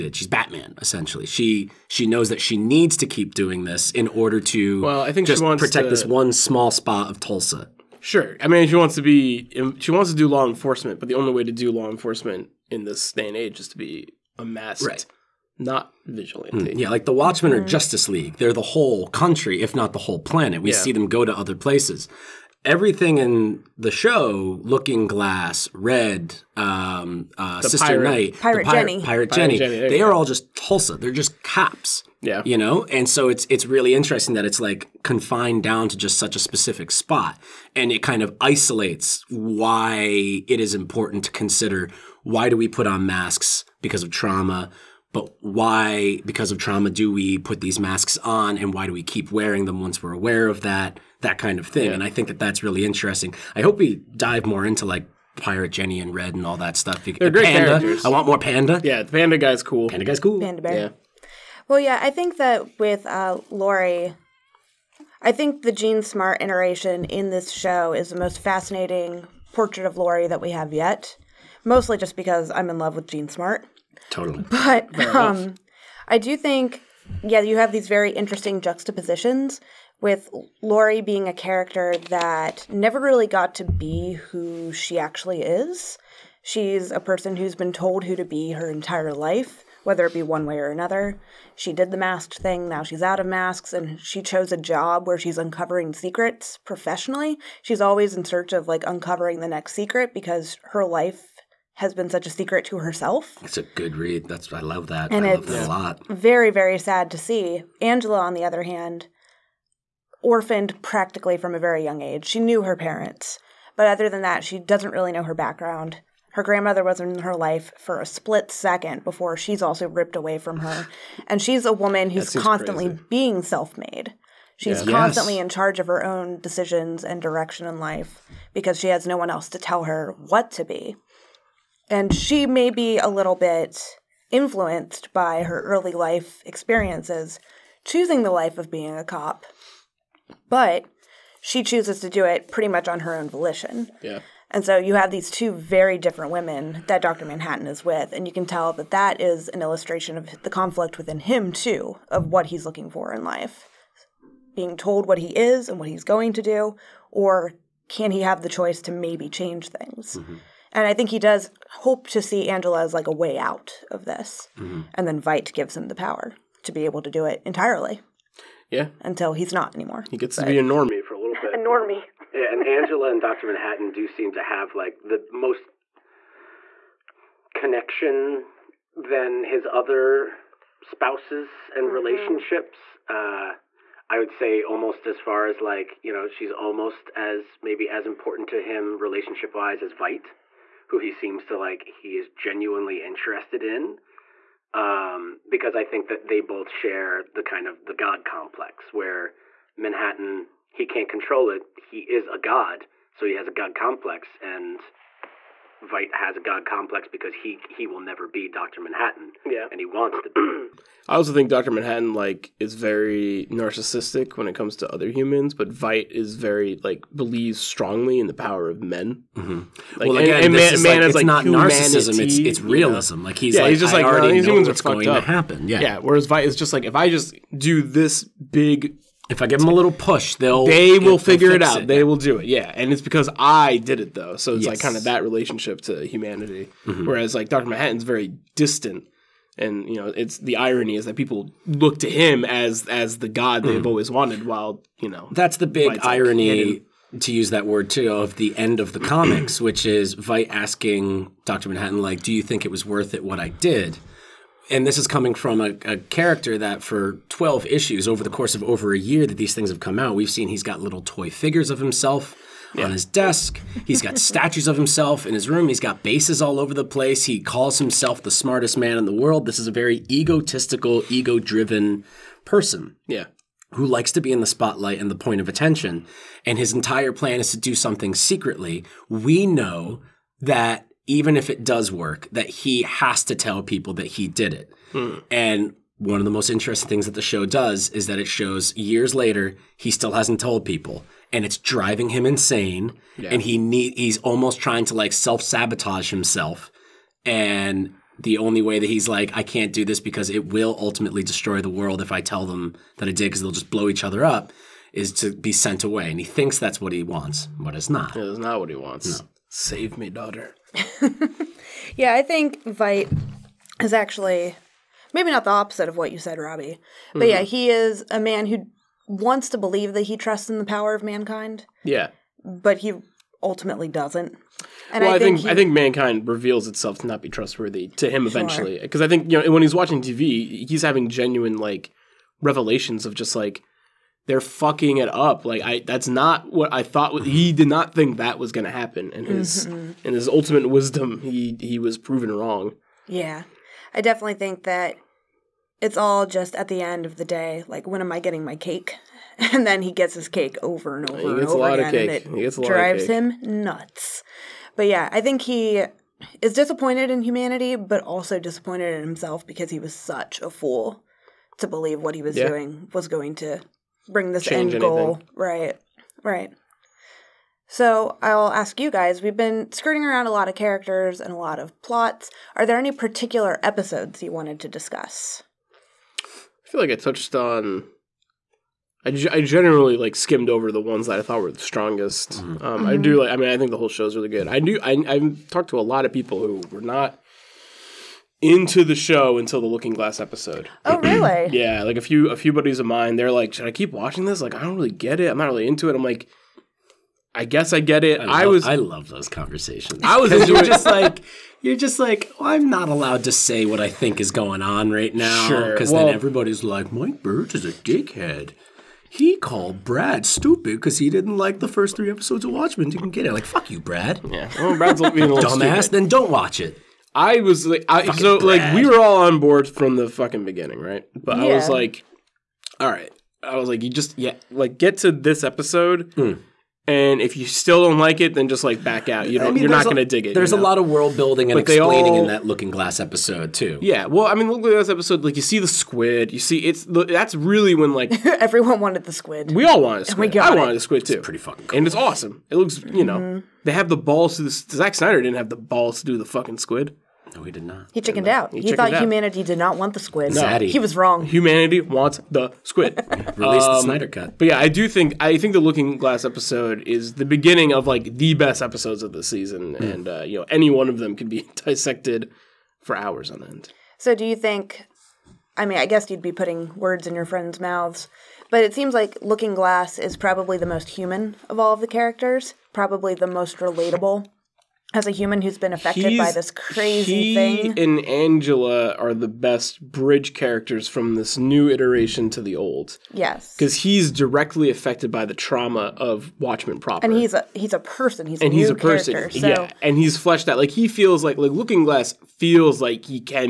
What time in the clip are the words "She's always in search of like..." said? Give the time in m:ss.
1:37.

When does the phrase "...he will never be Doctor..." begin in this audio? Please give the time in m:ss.
3:27.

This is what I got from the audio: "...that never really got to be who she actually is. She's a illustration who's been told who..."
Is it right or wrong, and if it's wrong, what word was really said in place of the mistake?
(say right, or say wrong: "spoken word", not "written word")
wrong: "person", not "illustration".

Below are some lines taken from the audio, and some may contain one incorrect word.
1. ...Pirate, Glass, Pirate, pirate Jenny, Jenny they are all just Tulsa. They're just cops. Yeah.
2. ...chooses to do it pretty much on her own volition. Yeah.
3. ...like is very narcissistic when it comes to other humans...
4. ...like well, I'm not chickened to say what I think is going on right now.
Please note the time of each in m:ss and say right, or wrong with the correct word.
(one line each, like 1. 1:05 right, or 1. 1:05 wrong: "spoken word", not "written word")
1. 0:28 wrong: "Jenny", not "Glass"
2. 2:21 right
3. 3:32 right
4. 6:41 wrong: "allowed", not "chickened".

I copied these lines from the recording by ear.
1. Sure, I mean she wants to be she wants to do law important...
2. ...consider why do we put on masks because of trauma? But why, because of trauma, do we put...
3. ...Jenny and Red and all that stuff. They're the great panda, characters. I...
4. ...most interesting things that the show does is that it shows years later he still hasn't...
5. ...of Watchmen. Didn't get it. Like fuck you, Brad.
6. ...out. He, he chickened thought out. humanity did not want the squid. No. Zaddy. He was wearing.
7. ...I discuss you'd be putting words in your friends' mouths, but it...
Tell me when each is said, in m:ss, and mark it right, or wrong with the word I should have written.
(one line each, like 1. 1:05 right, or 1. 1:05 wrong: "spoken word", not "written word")
1. 0:08 wrong: "enforcement", not "important"
2. 0:41 right
3. 0:55 right
4. 4:46 right
5. 6:52 right
6. 7:28 wrong: "wrong", not "wearing"
7. 7:45 wrong: "guess", not "discuss".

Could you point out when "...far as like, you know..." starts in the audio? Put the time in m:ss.
3:05.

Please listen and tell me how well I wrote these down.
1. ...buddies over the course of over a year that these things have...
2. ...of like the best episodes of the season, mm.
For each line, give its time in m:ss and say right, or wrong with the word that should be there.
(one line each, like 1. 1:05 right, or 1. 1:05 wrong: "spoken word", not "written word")
1. 4:17 wrong: "issues", not "buddies"
2. 7:37 right.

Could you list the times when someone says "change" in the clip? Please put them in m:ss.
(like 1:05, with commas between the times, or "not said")
2:39, 6:04.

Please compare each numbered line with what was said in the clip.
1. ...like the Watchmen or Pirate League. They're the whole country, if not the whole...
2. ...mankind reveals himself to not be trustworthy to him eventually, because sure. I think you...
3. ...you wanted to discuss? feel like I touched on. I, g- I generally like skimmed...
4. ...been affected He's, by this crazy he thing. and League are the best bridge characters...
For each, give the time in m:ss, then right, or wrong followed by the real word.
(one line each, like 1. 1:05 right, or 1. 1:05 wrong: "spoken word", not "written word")
1. 0:16 wrong: "Justice", not "Pirate"
2. 5:25 wrong: "itself", not "himself"
3. 6:14 right
4. 7:55 wrong: "Angela", not "League".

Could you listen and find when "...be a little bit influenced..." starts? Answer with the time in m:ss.
2:12.